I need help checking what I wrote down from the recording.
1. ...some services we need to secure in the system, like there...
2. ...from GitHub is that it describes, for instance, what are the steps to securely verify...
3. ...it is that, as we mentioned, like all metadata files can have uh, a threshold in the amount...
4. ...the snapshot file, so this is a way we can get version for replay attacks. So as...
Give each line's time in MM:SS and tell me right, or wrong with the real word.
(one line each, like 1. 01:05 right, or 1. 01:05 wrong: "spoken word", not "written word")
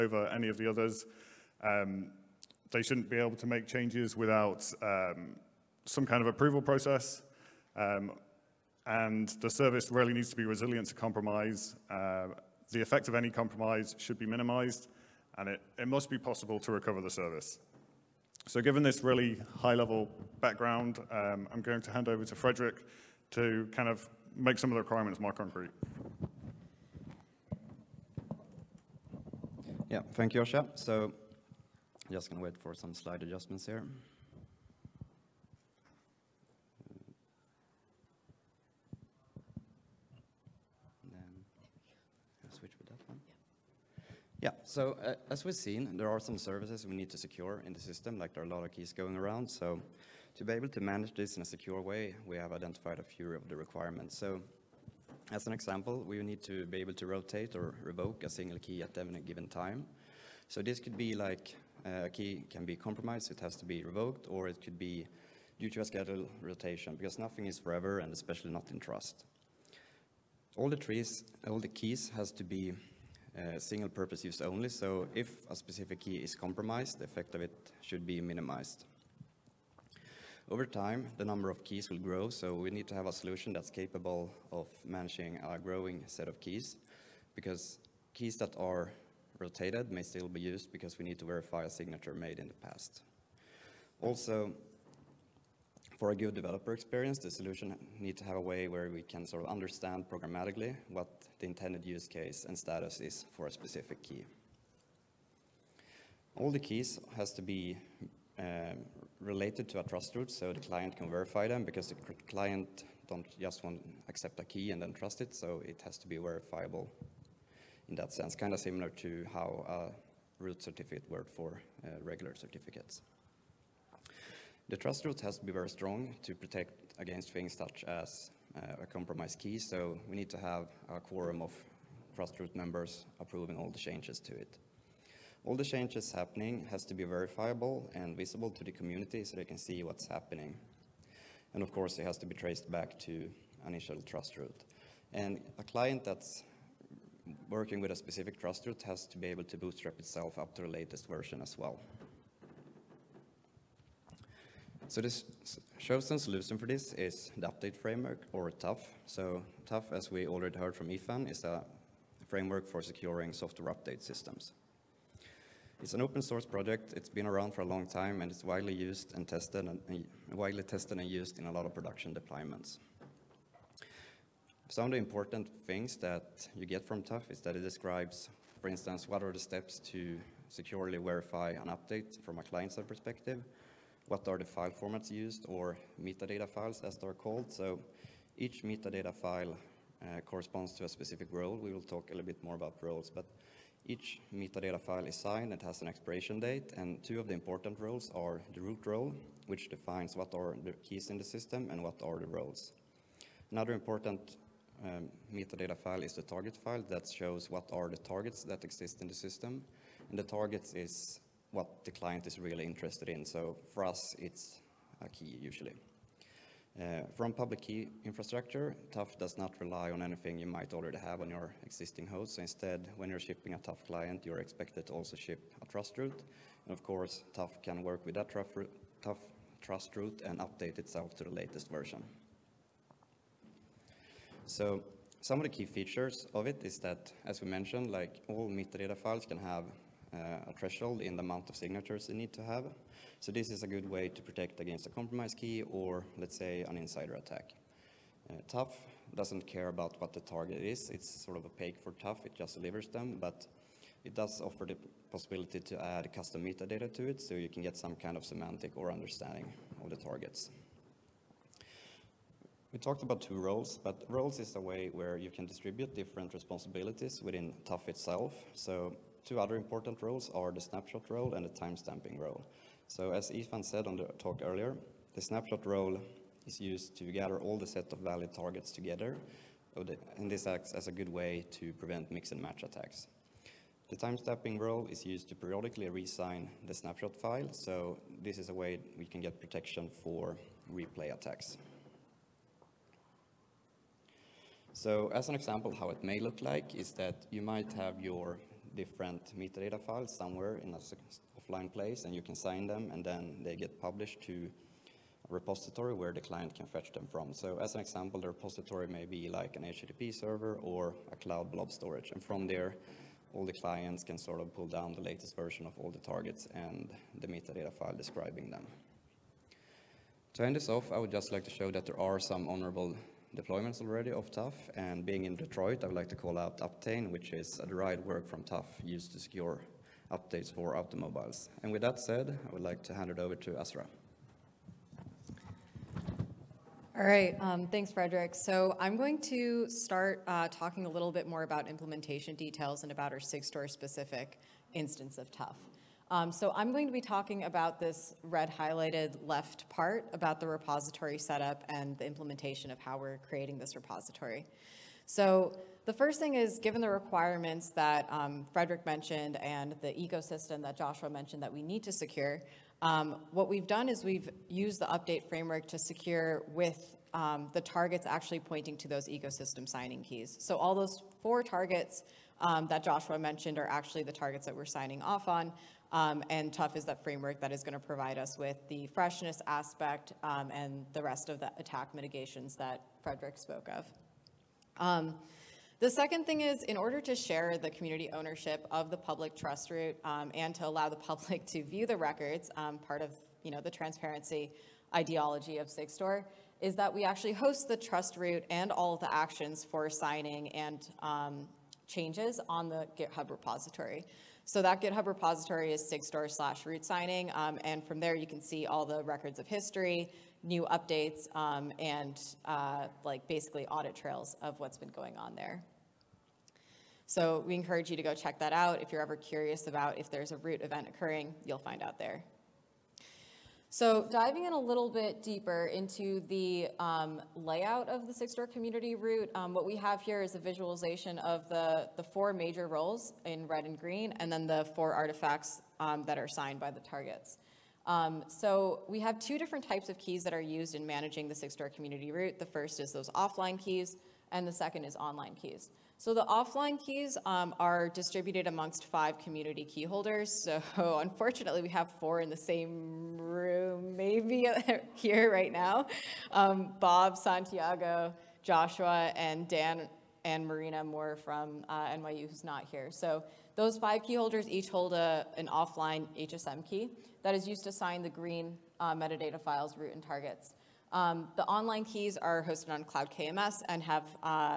1. 00:46 right
2. 02:56 wrong: "TUF", not "GitHub"
3. 03:56 right
4. 04:46 wrong: "protection", not "version".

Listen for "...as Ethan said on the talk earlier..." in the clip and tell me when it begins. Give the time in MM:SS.
04:33.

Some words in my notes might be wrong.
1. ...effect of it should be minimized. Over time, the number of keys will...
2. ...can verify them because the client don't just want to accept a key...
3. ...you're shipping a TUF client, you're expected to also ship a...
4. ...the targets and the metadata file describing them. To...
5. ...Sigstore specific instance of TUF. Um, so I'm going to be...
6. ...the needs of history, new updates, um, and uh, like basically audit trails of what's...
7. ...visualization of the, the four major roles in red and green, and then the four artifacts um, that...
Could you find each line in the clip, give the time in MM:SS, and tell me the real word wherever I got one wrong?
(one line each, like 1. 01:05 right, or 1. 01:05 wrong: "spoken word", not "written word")
1. 01:17 right
2. 01:50 right
3. 03:43 right
4. 05:15 right
5. 05:43 right
6. 06:48 wrong: "records", not "needs"
7. 07:10 right.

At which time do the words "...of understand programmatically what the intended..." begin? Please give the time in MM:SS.
01:39.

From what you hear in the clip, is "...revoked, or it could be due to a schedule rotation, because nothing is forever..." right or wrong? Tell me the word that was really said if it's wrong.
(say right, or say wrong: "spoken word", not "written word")
right.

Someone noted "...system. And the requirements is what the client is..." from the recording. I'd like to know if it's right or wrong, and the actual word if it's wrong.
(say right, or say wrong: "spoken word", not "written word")
wrong: "targets", not "requirements".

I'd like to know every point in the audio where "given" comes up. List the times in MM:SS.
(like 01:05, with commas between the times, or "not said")
00:18, 00:59, 05:56.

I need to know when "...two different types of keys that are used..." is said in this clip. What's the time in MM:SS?
07:19.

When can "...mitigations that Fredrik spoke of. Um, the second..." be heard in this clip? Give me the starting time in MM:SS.
06:21.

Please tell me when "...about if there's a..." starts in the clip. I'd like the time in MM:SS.
06:59.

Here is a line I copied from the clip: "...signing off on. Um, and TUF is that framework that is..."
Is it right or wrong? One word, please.
right.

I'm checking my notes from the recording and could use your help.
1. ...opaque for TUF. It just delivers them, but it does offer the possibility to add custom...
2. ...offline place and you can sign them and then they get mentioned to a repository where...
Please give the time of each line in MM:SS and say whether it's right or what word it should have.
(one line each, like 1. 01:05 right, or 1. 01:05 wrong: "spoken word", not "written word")
1. 04:11 right
2. 05:01 wrong: "published", not "mentioned".